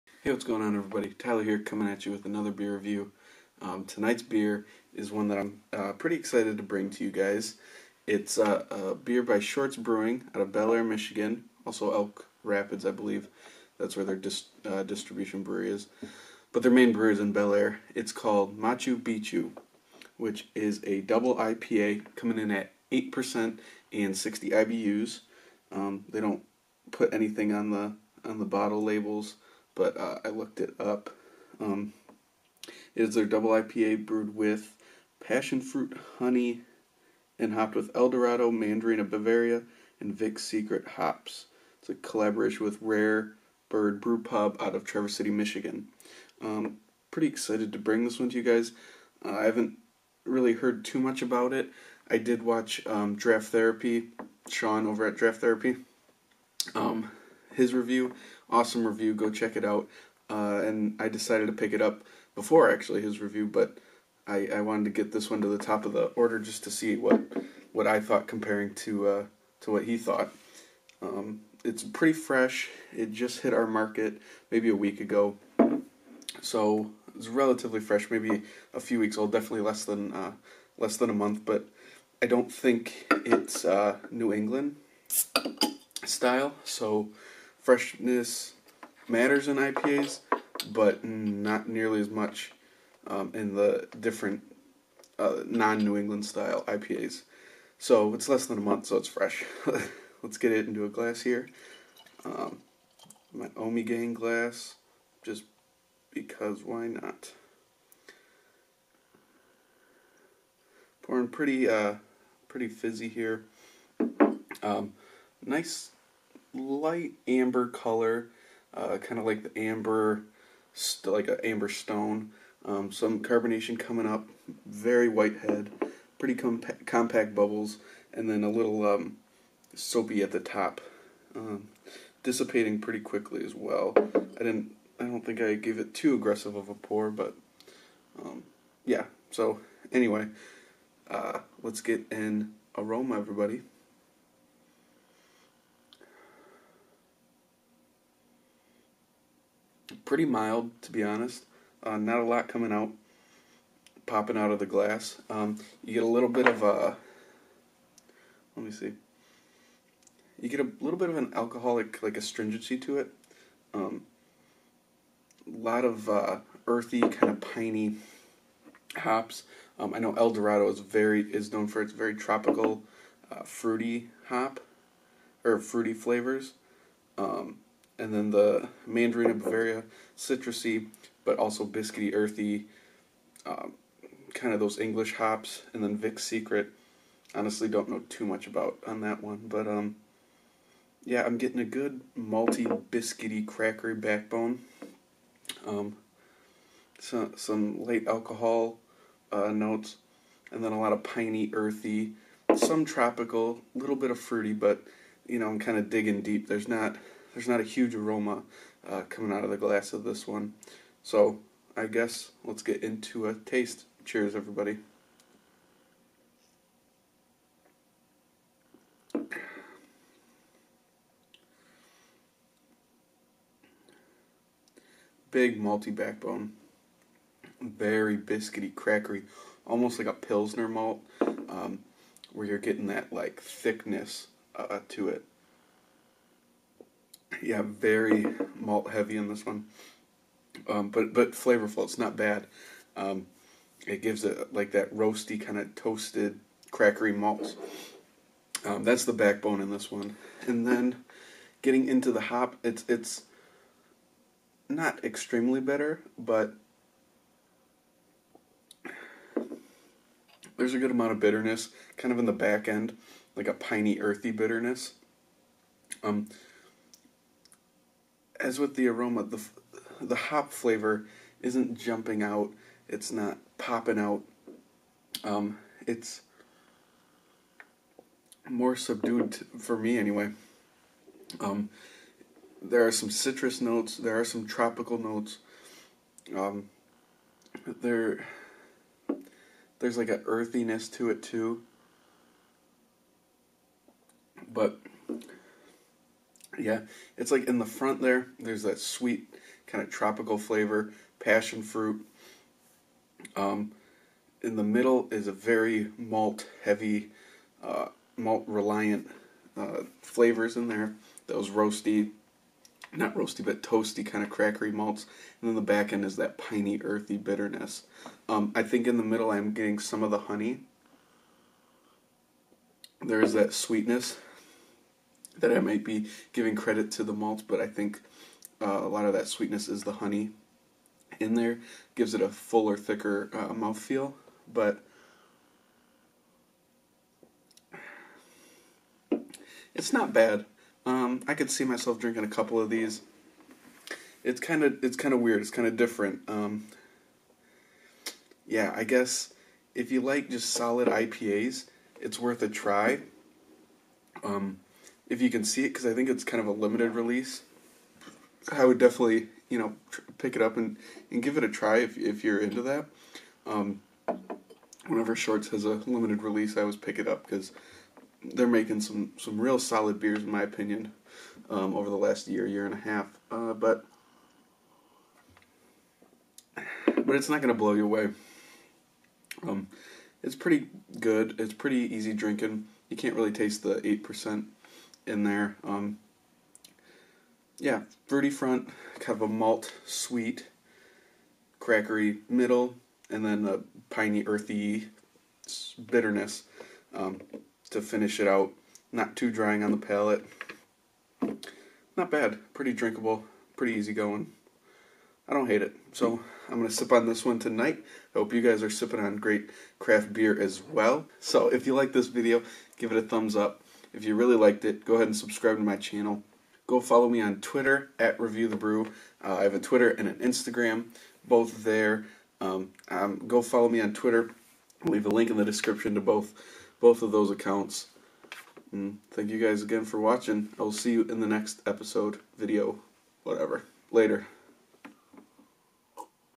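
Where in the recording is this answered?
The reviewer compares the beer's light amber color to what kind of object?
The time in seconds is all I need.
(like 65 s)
121 s.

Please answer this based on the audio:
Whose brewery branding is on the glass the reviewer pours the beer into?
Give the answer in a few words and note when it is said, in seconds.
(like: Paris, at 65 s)
Ommegang, at 103 s.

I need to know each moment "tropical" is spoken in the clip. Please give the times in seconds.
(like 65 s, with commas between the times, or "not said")
172 s, 202 s, 284 s, 299 s.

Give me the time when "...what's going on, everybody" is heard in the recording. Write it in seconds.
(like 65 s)
0 s.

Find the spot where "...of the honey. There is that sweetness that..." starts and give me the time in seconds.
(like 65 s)
320 s.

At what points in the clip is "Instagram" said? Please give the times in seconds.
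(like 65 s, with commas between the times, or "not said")
420 s.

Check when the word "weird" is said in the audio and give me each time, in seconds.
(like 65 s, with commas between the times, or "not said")
345 s.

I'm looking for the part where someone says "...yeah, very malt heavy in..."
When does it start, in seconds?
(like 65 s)
237 s.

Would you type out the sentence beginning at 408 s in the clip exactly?
I hope you guys are sipping on great craft beer as well.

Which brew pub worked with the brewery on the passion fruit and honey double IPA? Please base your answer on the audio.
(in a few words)
Rare Bird Brew Pub.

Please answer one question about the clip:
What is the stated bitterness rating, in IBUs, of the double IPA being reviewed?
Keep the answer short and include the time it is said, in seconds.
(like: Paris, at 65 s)
60, at 24 s.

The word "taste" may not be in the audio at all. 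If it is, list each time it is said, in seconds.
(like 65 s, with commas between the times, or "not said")
213 s, 383 s.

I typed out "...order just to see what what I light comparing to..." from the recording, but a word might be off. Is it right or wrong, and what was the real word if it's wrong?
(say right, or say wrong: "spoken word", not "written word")
wrong: "thought", not "light".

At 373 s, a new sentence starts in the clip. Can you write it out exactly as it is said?
Uh, but but it's not gonna blow you away.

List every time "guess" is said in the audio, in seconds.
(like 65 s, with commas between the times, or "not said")
211 s, 348 s.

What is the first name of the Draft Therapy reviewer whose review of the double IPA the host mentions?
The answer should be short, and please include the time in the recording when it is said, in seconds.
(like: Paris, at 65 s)
Sean, at 54 s.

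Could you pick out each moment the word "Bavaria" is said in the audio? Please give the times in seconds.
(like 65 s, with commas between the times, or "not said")
39 s, 179 s.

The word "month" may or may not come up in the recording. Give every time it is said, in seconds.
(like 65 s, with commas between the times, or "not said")
81 s, 98 s.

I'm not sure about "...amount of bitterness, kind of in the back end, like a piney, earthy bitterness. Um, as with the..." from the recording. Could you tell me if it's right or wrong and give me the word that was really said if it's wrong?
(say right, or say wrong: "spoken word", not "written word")
right.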